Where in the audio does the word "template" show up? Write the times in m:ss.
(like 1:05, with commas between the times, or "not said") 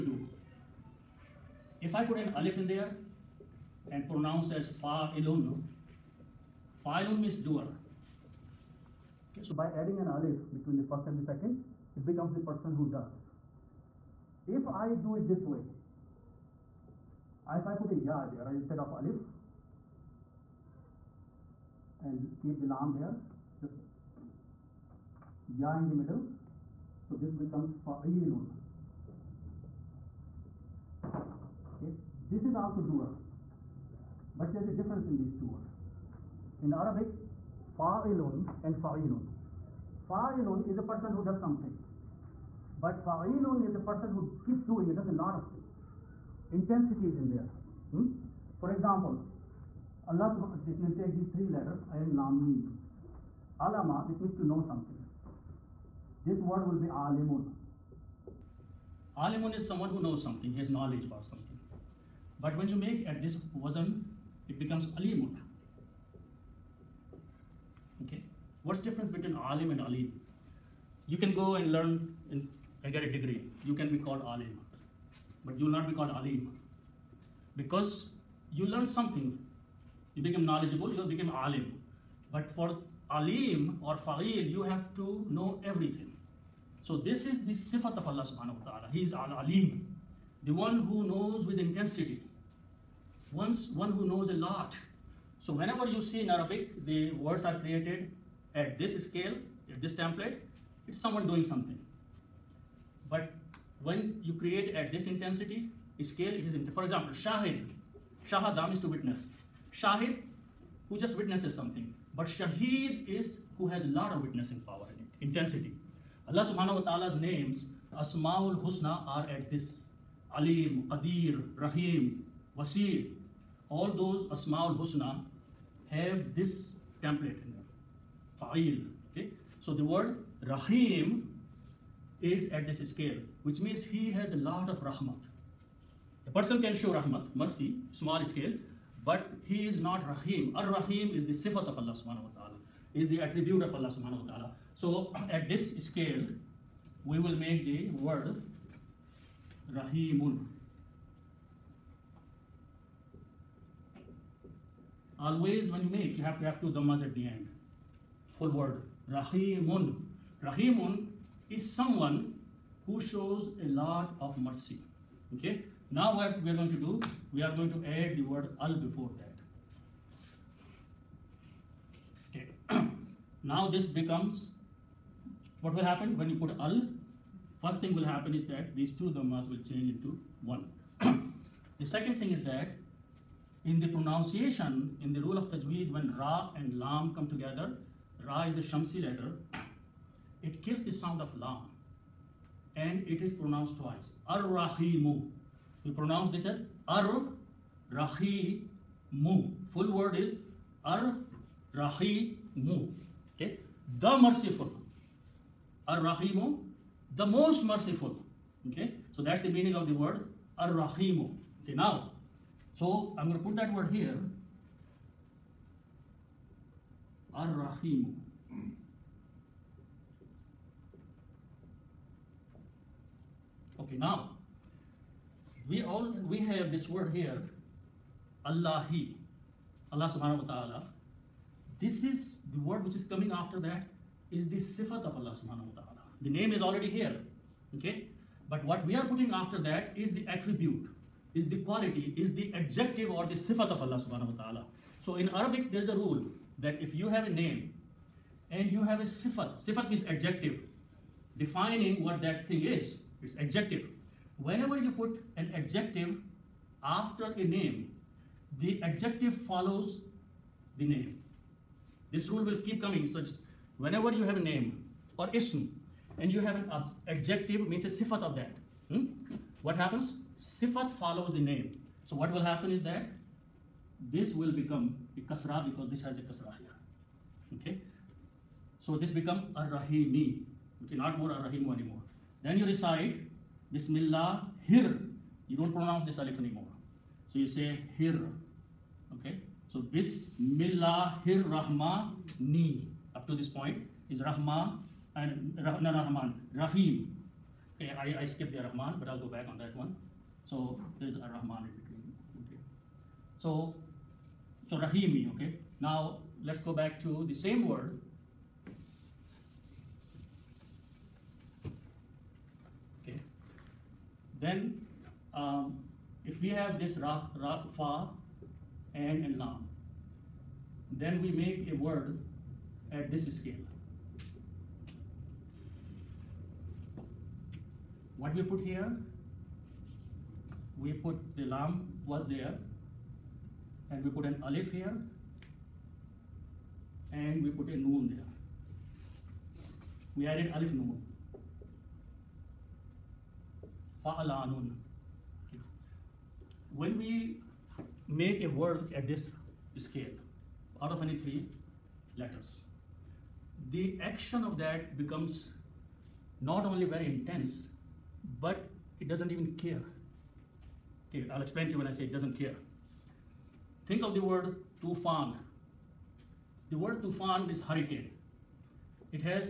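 1:39, 2:07.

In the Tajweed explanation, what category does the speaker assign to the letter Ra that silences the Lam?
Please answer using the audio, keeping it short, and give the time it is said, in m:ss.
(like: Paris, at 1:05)
Shamsi letter, at 3:08.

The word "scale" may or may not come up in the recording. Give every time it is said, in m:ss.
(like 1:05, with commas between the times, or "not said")
1:39, 1:46, 2:12, 2:18, 2:25, 5:23, 5:49.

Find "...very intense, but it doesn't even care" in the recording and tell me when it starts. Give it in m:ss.
5:56.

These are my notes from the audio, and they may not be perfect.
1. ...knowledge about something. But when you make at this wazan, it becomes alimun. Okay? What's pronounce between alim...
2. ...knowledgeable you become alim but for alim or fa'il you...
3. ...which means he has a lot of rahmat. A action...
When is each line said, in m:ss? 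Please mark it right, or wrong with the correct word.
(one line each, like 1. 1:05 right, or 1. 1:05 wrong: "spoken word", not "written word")
1. 1:00 wrong: "difference", not "pronounce"
2. 1:20 right
3. 2:13 wrong: "person", not "action".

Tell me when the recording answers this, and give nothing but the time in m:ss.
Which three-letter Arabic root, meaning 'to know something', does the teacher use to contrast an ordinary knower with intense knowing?
0:53.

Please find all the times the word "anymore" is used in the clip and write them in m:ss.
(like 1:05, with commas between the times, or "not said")
4:41, 4:46.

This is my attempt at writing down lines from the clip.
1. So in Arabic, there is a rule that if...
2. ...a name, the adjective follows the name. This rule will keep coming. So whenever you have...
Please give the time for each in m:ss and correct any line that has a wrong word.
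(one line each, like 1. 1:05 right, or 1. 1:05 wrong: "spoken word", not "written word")
1. 4:05 right
2. 4:17 right.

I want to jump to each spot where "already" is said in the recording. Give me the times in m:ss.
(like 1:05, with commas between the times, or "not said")
3:56.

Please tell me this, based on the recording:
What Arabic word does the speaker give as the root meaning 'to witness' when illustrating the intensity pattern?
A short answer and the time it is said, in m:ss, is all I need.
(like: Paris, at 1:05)
shahadam, at 1:48.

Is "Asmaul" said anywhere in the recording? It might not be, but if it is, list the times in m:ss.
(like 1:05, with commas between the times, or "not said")
1:57, 2:04.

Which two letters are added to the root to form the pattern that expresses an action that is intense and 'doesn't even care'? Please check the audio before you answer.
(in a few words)
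alif noon.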